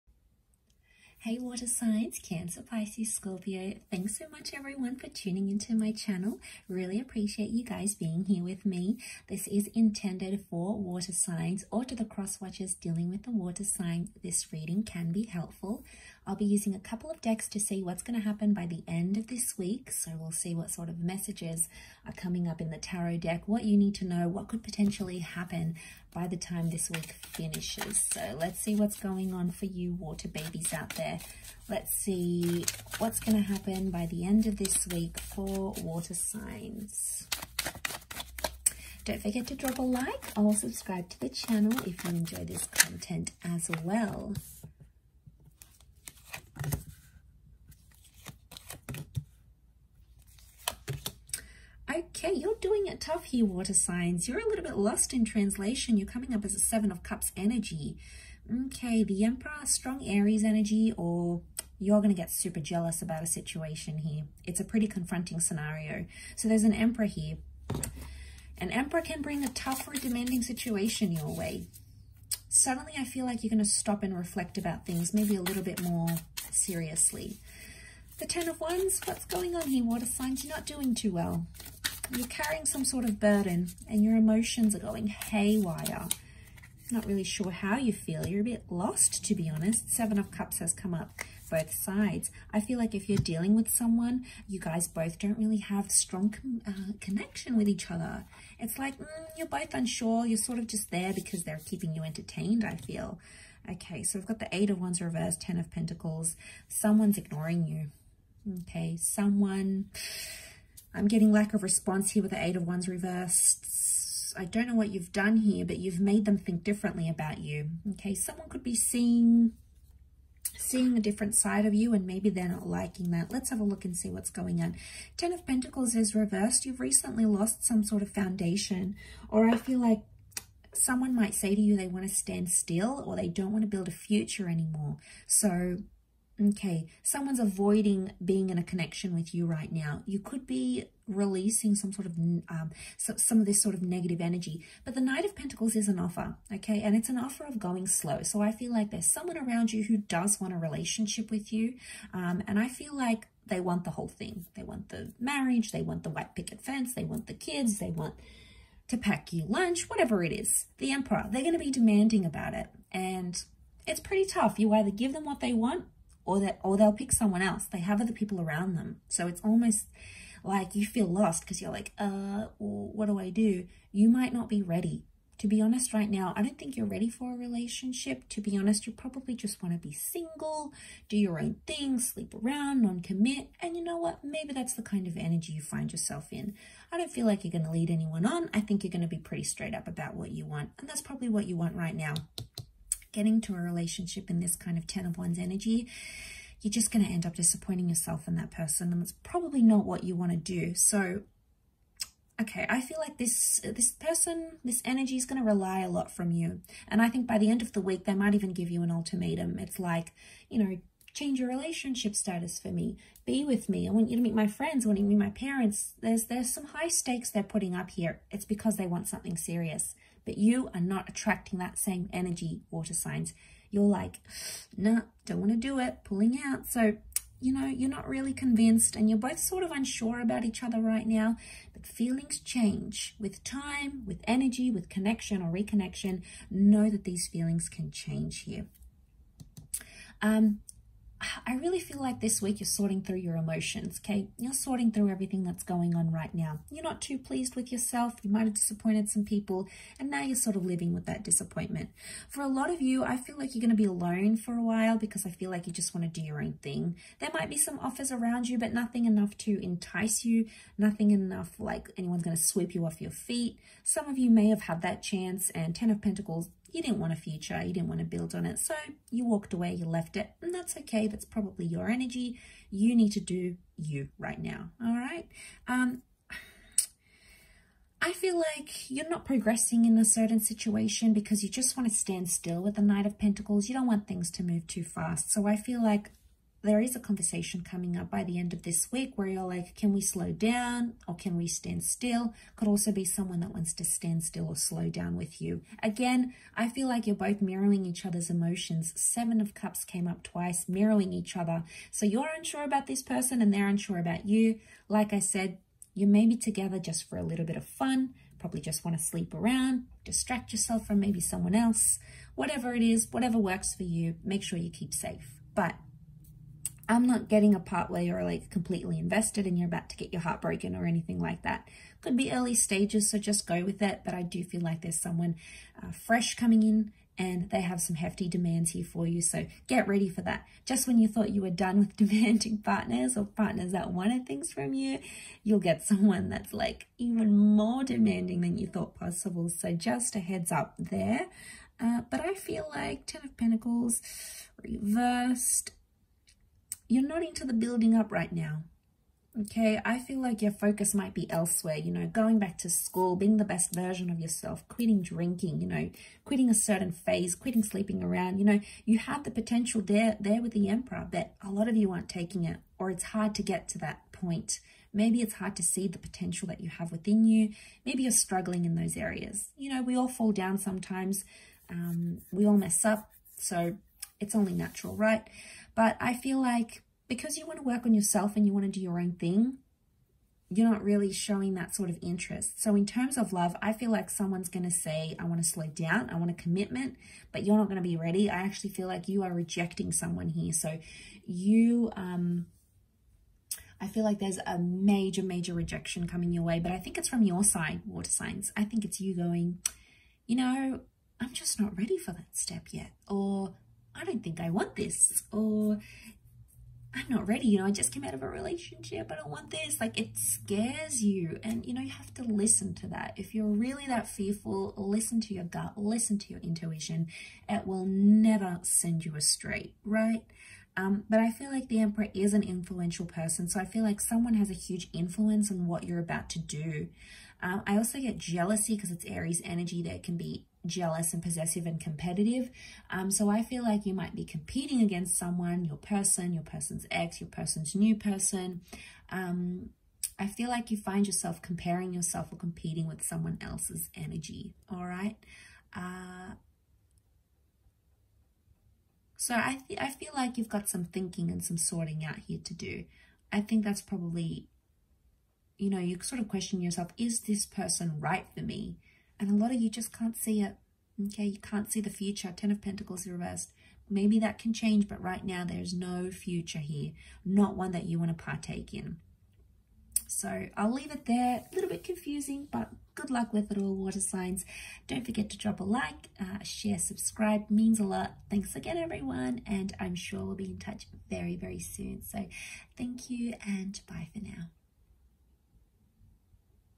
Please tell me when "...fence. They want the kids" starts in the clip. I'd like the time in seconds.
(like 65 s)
156 s.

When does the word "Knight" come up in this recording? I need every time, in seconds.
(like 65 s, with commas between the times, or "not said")
145 s, 282 s.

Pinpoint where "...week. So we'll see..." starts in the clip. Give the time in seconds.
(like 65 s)
19 s.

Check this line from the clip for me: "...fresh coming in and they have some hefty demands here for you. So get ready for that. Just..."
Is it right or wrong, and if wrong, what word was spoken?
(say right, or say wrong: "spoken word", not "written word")
right.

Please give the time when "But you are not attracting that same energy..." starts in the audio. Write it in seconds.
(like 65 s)
220 s.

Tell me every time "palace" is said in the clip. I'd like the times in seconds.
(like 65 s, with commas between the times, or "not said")
not said.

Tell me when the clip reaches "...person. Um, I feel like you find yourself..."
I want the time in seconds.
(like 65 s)
437 s.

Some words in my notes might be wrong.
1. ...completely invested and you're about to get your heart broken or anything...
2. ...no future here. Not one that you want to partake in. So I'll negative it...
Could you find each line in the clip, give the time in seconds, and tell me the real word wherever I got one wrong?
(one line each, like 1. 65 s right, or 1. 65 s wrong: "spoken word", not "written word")
1. 318 s right
2. 465 s wrong: "leave", not "negative".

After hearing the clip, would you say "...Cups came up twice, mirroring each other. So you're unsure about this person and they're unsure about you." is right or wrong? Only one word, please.
right.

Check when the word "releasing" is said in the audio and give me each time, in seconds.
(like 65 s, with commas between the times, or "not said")
141 s.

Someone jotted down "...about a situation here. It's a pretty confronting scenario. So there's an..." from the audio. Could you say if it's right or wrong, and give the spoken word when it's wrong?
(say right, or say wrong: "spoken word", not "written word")
right.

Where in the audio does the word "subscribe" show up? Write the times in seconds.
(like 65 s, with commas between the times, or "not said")
40 s, 476 s.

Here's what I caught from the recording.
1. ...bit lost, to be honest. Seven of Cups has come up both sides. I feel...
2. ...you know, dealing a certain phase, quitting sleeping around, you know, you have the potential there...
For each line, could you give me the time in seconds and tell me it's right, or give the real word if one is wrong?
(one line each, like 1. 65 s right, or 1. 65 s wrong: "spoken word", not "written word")
1. 88 s right
2. 355 s wrong: "quitting", not "dealing".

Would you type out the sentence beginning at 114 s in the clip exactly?
I don't know what you've done here, but you've made them think differently about you.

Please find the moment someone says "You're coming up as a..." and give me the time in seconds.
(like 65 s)
55 s.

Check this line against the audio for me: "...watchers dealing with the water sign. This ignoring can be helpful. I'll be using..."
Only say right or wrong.
wrong.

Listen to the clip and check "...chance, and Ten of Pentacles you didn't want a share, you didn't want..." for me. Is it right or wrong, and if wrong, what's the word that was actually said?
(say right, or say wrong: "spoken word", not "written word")
wrong: "future", not "share".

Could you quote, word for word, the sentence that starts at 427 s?
Um, I also get jealousy because it's Aries energy.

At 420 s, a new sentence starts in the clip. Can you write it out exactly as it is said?
Um, but I feel like the emperor is an influential person.